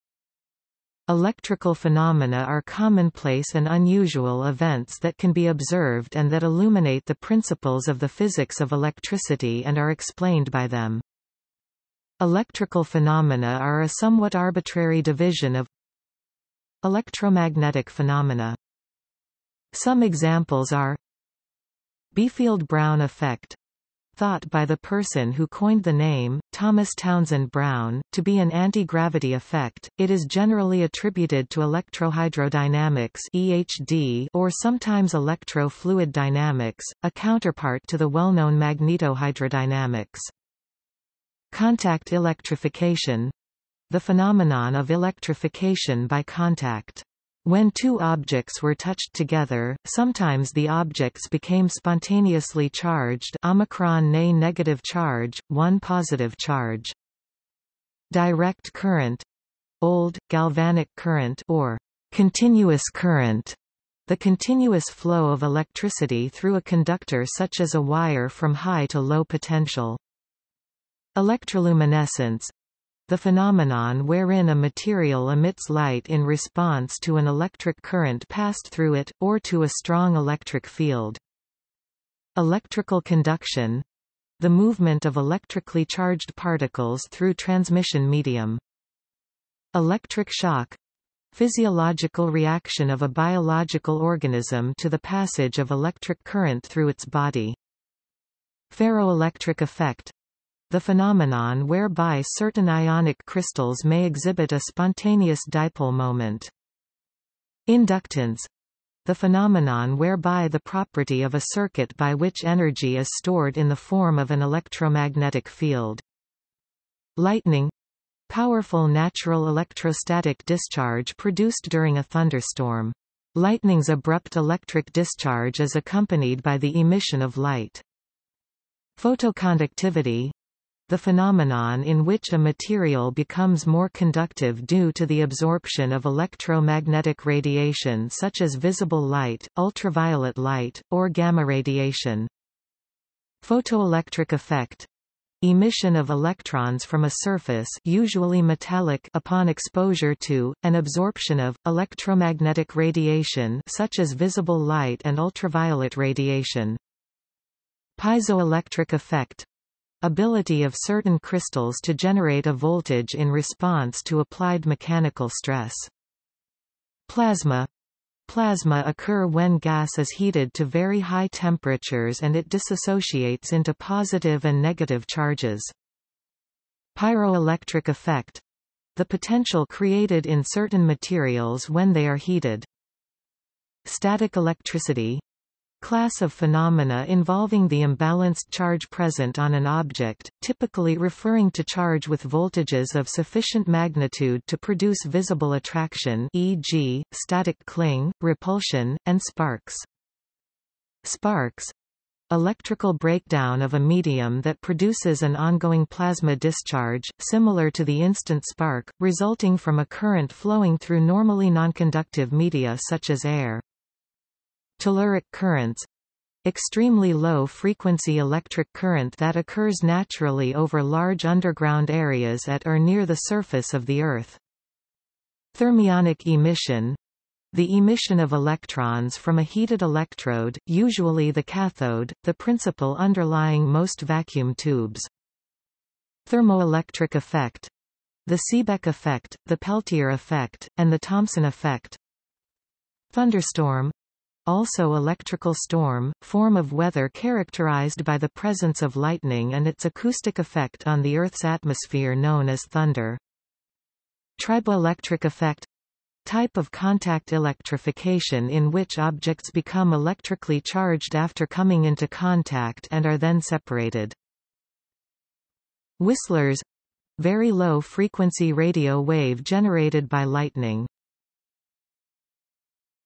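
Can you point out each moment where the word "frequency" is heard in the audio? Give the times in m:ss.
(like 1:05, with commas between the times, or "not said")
3:37, 4:27.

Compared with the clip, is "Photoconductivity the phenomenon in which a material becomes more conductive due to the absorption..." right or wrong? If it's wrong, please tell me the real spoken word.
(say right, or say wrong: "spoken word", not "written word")
right.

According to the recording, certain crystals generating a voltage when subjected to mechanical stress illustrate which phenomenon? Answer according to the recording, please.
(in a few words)
Piezoelectric effect.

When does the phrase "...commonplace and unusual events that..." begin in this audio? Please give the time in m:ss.
0:02.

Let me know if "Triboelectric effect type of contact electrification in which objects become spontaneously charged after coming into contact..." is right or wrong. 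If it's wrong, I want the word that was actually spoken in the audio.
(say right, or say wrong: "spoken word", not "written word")
wrong: "electrically", not "spontaneously".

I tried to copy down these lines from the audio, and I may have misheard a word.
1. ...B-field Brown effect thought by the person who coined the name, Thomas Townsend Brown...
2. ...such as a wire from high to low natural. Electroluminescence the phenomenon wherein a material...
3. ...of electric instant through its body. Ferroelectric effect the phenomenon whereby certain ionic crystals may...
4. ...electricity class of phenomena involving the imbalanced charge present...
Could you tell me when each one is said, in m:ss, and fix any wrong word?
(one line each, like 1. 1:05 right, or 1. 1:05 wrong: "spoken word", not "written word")
1. 0:22 right
2. 1:07 wrong: "potential", not "natural"
3. 1:35 wrong: "current", not "instant"
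4. 3:04 right.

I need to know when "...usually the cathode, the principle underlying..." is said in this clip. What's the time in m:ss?
3:50.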